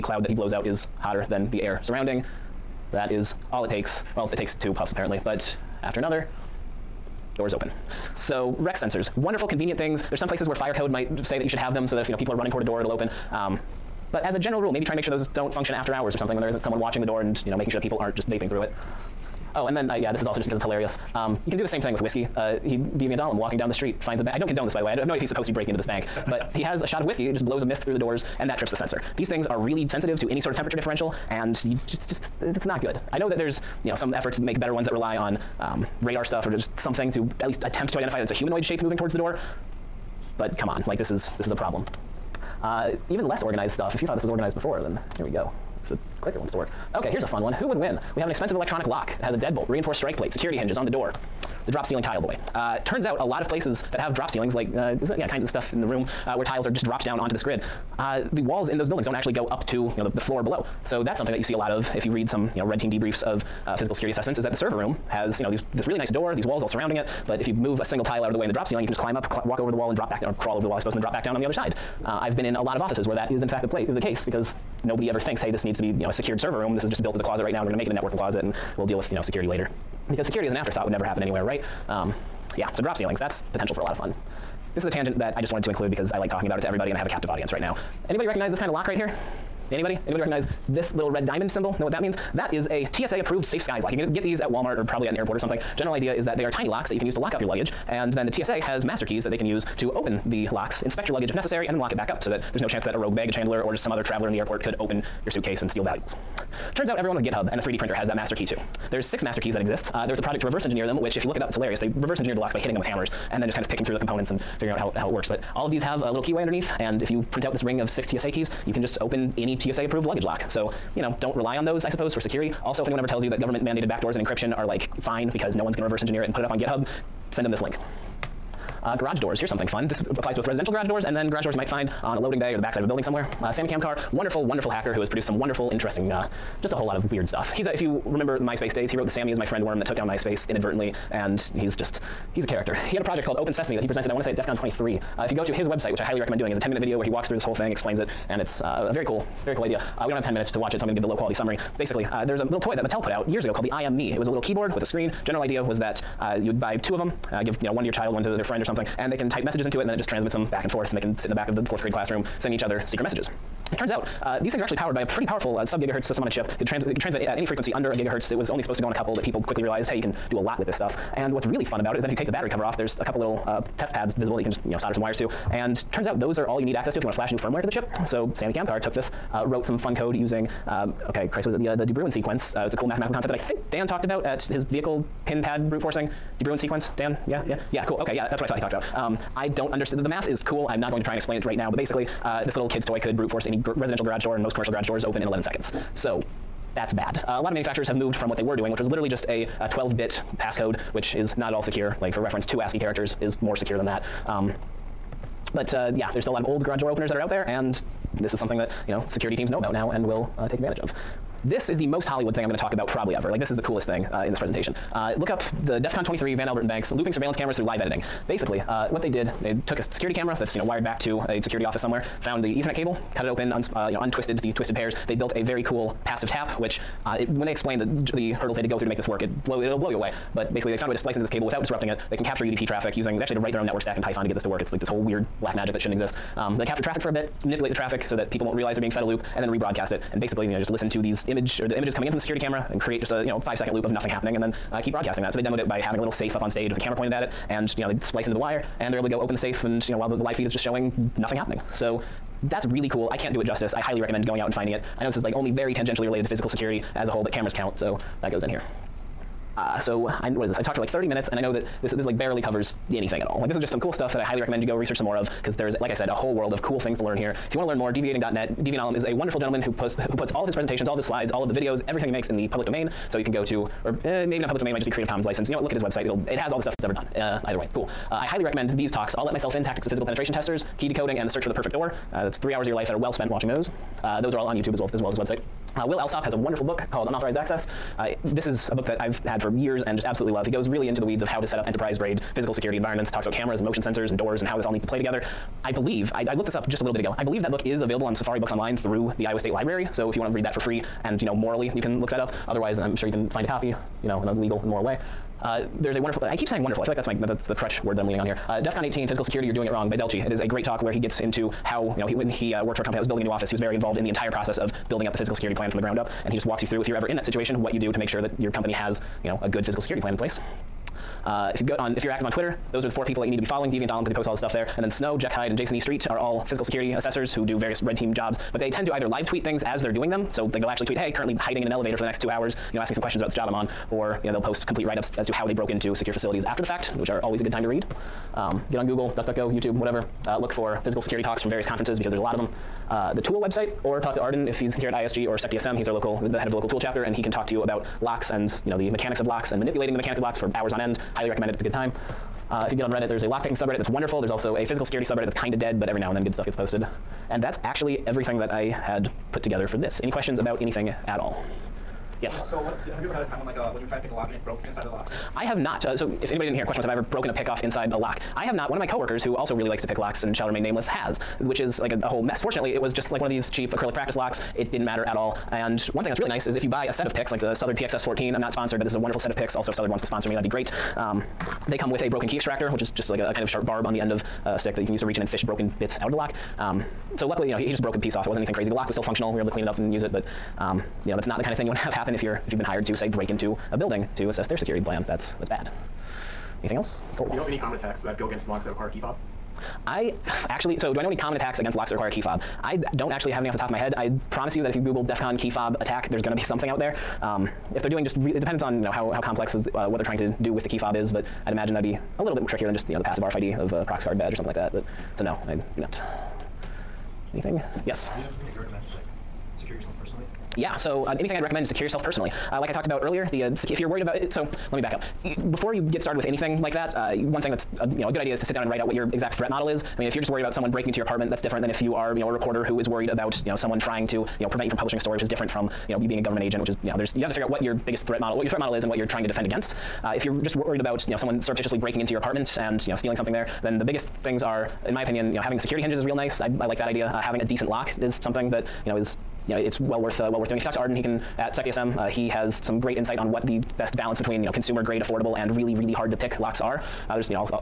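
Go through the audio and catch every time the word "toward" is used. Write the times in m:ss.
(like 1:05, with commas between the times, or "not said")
0:12, 0:38.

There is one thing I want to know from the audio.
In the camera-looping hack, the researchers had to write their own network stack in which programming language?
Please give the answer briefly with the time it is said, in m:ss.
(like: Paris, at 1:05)
Python, at 3:54.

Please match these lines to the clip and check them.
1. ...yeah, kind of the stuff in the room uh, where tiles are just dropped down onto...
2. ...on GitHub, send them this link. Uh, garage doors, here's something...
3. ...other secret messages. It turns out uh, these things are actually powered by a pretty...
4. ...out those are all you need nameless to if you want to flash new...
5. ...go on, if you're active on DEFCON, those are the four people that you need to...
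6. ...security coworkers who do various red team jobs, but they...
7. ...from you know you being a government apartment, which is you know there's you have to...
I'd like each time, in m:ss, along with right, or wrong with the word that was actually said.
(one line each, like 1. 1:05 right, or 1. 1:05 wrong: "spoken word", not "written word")
1. 0:55 right
2. 2:06 right
3. 2:42 right
4. 2:56 wrong: "access", not "nameless"
5. 5:21 wrong: "Twitter", not "DEFCON"
6. 5:26 wrong: "assessors", not "coworkers"
7. 7:15 wrong: "agent", not "apartment".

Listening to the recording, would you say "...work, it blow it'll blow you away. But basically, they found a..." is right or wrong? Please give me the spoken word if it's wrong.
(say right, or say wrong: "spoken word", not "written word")
right.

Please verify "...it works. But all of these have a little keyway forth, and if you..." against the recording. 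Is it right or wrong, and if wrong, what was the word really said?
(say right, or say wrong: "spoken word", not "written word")
wrong: "underneath", not "forth".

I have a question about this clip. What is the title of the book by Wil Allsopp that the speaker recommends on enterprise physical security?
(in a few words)
Unauthorized Access.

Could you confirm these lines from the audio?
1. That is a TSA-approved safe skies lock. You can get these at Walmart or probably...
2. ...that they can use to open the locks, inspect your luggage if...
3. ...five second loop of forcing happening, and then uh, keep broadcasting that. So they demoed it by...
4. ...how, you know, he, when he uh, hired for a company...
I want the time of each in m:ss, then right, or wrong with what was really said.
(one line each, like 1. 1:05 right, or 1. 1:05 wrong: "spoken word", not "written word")
1. 1:32 right
2. 1:39 right
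3. 4:03 wrong: "nothing", not "forcing"
4. 5:11 wrong: "worked", not "hired".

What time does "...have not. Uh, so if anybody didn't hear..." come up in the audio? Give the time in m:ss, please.
6:05.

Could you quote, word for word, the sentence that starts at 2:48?
It was only supposed to go on a couple, but people quickly realized, hey, you can do a lot with this stuff.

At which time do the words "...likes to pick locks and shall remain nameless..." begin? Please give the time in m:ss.
6:09.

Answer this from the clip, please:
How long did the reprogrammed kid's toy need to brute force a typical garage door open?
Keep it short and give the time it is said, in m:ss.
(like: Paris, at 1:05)
11 seconds, at 3:15.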